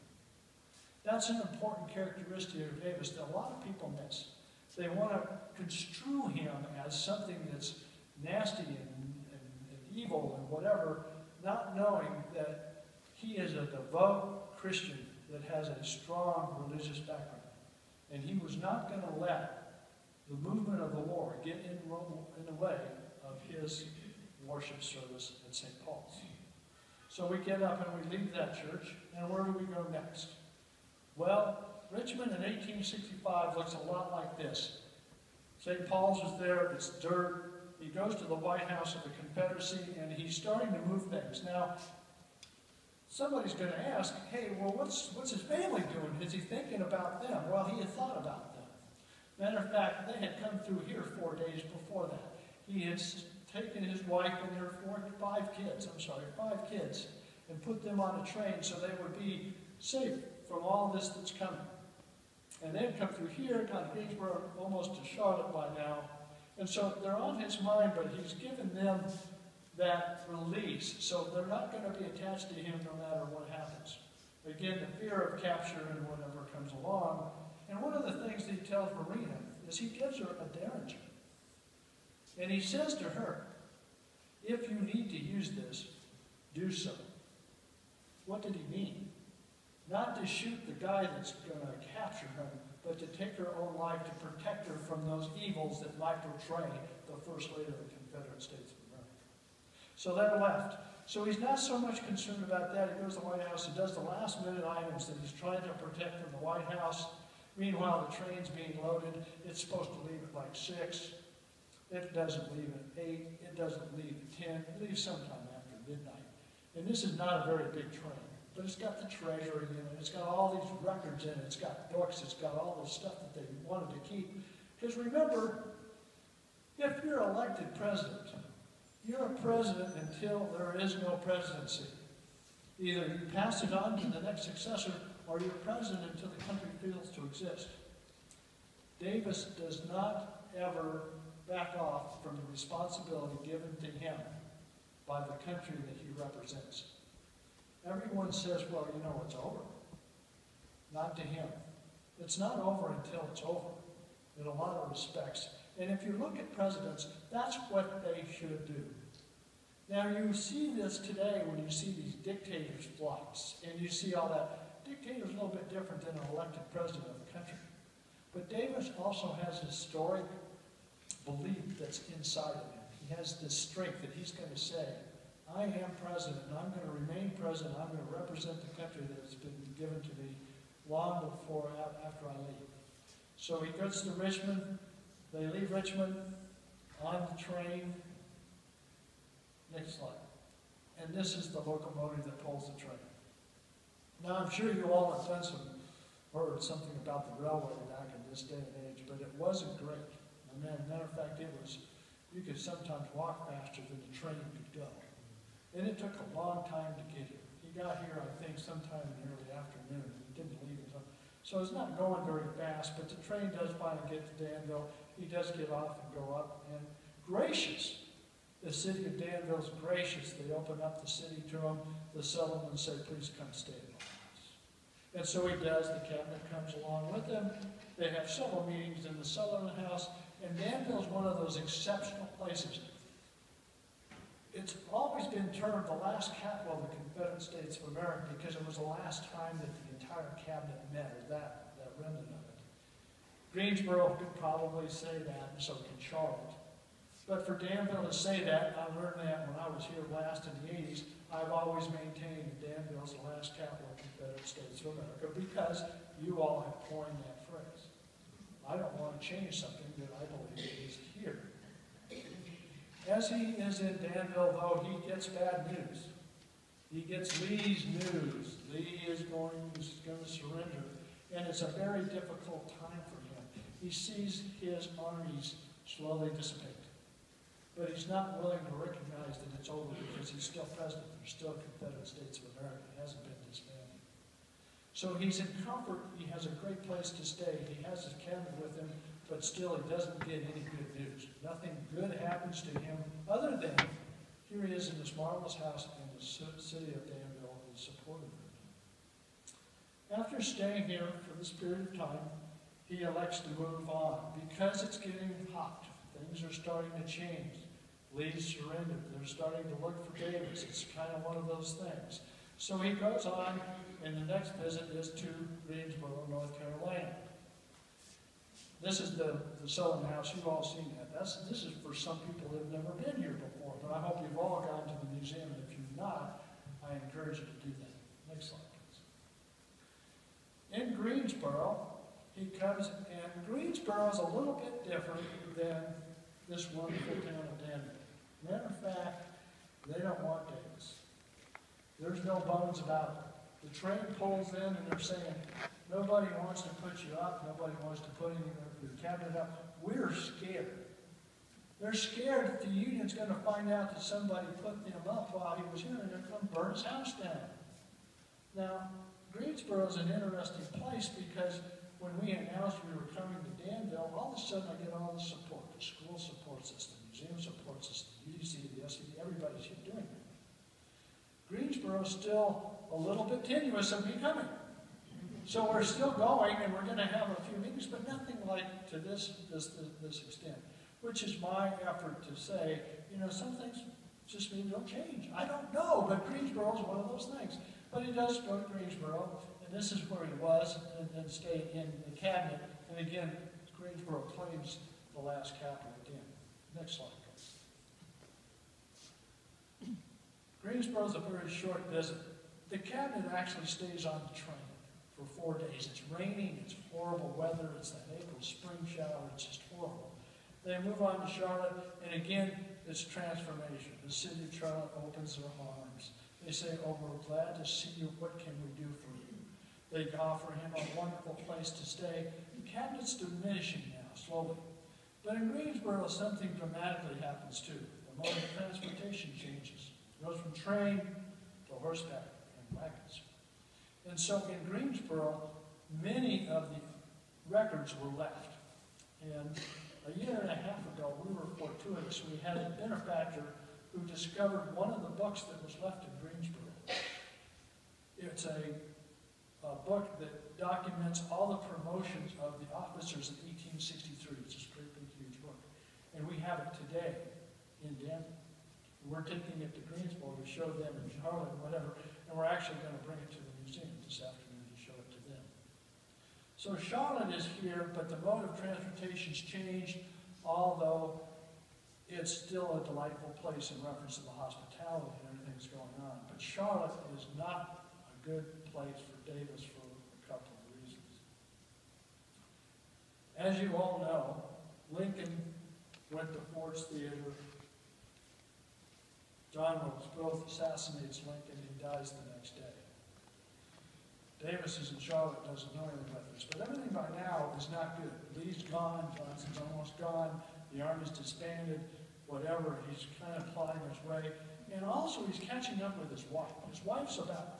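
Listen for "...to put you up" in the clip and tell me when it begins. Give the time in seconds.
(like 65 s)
346 s.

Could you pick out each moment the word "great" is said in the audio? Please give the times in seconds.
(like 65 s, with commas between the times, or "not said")
199 s, 286 s, 454 s.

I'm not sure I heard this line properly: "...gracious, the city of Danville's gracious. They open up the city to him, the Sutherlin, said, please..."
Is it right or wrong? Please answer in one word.
right.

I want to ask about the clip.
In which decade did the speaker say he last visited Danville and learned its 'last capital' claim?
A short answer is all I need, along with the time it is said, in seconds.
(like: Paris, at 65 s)
The 80s, at 250 s.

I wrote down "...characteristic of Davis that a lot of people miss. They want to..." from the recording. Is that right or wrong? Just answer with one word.
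right.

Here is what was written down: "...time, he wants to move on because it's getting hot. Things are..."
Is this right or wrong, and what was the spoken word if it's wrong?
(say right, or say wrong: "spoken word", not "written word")
wrong: "elects", not "wants".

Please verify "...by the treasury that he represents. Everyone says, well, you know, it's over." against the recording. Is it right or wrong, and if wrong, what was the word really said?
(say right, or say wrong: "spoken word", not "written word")
wrong: "country", not "treasury".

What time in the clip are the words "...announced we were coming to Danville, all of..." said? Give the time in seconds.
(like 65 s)
362 s.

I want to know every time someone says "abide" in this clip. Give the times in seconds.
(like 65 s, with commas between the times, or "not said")
not said.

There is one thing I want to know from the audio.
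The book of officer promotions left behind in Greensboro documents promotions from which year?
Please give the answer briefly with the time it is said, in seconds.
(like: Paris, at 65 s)
1863, at 453 s.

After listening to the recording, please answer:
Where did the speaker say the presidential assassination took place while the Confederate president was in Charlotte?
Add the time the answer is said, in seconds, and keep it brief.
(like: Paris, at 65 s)
Ford's Theater, at 486 s.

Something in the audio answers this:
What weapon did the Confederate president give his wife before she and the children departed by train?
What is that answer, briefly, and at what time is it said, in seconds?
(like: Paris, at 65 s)
A derringer, at 80 s.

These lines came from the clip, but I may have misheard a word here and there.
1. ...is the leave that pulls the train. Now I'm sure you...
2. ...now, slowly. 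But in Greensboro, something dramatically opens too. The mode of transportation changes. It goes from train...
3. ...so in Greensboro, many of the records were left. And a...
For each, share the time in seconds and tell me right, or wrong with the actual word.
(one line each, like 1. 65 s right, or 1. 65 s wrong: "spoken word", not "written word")
1. 191 s wrong: "locomotive", not "leave"
2. 423 s wrong: "happens", not "opens"
3. 434 s right.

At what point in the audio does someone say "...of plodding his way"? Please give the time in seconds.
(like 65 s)
503 s.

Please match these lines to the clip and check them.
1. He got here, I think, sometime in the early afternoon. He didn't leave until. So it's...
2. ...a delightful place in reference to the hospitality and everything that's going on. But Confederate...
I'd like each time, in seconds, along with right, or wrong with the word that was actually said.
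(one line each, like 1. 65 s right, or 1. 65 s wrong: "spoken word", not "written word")
1. 207 s right
2. 472 s wrong: "Charlotte", not "Confederate".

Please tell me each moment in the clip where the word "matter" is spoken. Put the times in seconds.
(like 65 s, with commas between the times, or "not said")
49 s, 73 s, 200 s, 338 s.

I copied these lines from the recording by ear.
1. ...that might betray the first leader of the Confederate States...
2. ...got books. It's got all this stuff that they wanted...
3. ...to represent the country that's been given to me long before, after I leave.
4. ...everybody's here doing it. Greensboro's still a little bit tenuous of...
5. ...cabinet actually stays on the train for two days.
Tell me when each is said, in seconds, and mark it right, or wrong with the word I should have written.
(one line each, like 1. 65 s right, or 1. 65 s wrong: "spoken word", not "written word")
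1. 95 s right
2. 121 s right
3. 178 s right
4. 369 s right
5. 402 s wrong: "four", not "two".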